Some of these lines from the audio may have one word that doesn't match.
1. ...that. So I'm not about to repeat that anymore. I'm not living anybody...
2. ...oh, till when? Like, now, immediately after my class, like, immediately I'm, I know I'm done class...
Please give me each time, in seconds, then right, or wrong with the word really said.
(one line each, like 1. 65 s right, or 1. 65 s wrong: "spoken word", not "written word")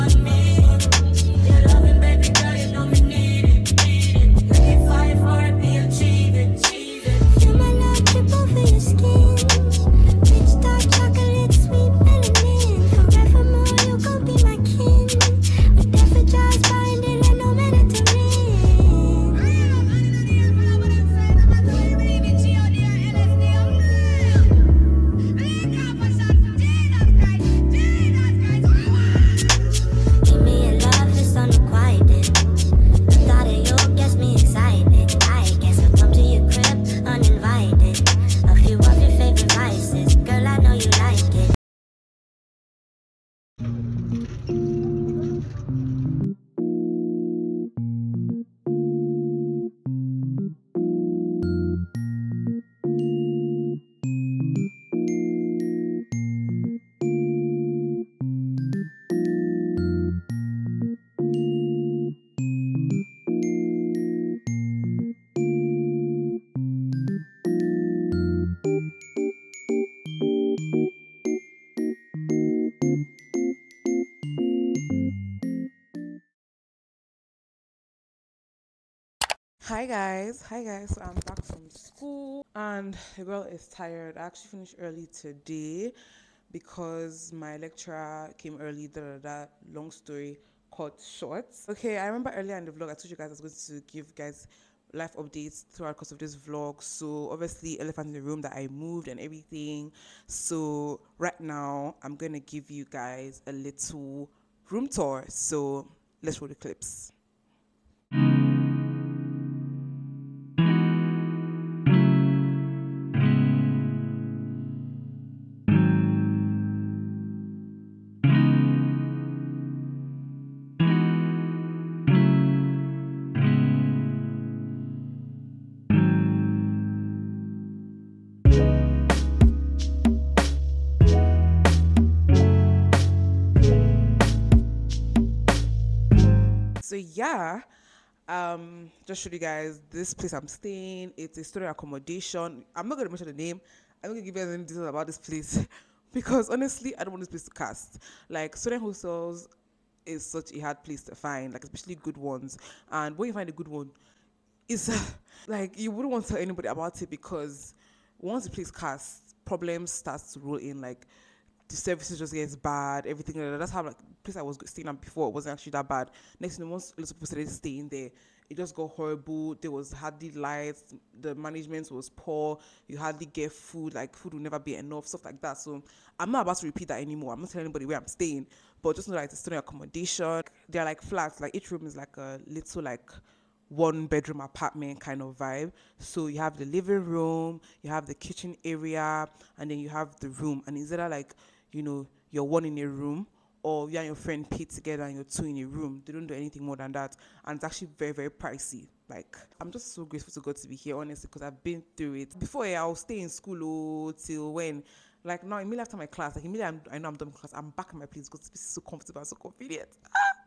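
1. 175 s wrong: "telling", not "living"
2. 204 s right.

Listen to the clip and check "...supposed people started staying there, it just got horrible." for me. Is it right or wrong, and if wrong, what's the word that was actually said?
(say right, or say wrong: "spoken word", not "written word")
right.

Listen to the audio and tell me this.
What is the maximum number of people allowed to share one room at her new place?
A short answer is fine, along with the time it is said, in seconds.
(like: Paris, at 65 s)
2, at 195 s.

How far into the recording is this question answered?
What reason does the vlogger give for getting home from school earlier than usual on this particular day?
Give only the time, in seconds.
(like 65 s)
87 s.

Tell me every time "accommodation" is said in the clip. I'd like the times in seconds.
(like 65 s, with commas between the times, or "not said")
141 s, 179 s.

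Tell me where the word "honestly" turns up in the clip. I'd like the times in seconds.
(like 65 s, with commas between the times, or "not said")
146 s, 200 s.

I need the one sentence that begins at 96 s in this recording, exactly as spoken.
So obviously elephant in the room that I moved and everything.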